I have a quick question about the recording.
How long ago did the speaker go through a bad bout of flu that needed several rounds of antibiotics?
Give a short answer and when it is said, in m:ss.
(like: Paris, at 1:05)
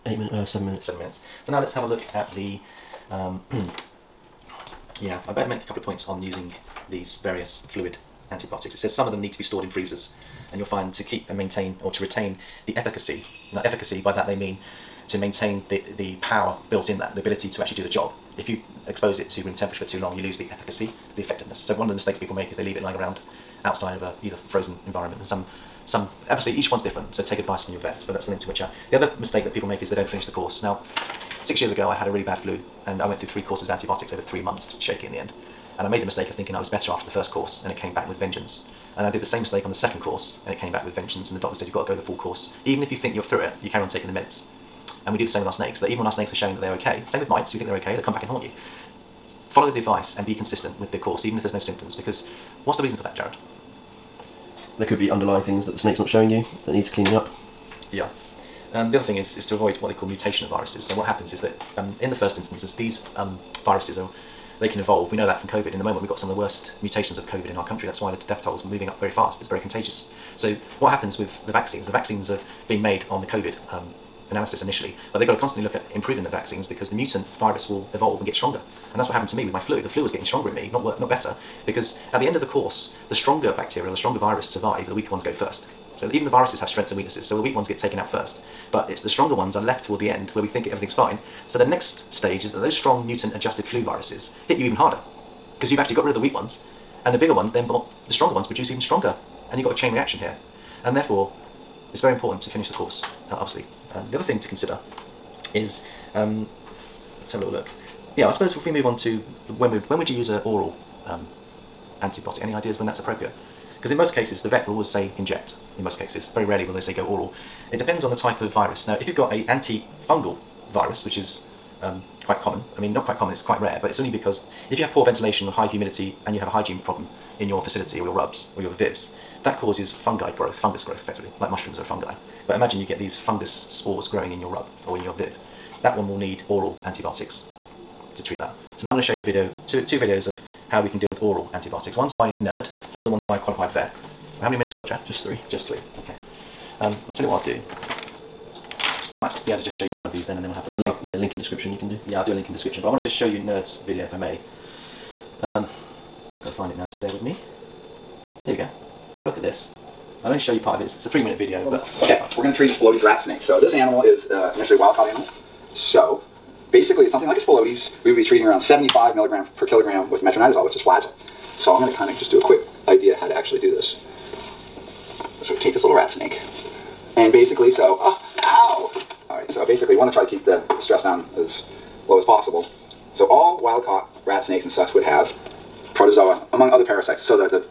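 6 years, at 0:31.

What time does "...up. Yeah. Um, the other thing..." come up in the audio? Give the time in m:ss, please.
0:57.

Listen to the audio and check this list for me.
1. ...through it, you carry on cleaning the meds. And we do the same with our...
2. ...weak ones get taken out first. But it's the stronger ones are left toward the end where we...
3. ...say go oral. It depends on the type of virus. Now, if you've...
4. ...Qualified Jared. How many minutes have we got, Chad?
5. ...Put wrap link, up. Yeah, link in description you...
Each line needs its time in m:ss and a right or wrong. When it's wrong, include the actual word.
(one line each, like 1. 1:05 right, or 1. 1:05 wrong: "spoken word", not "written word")
1. 0:43 wrong: "taking", not "cleaning"
2. 1:27 right
3. 1:56 right
4. 2:23 wrong: "Vet", not "Jared"
5. 2:30 right.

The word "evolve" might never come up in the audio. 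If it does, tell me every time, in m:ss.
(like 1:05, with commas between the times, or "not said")
1:04, 1:17.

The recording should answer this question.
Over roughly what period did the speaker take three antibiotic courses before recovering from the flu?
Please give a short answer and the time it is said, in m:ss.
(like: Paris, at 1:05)
3 months, at 0:34.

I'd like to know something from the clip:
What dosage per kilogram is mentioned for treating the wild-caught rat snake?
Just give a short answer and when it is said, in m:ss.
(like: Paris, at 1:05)
75 milligrams, at 2:48.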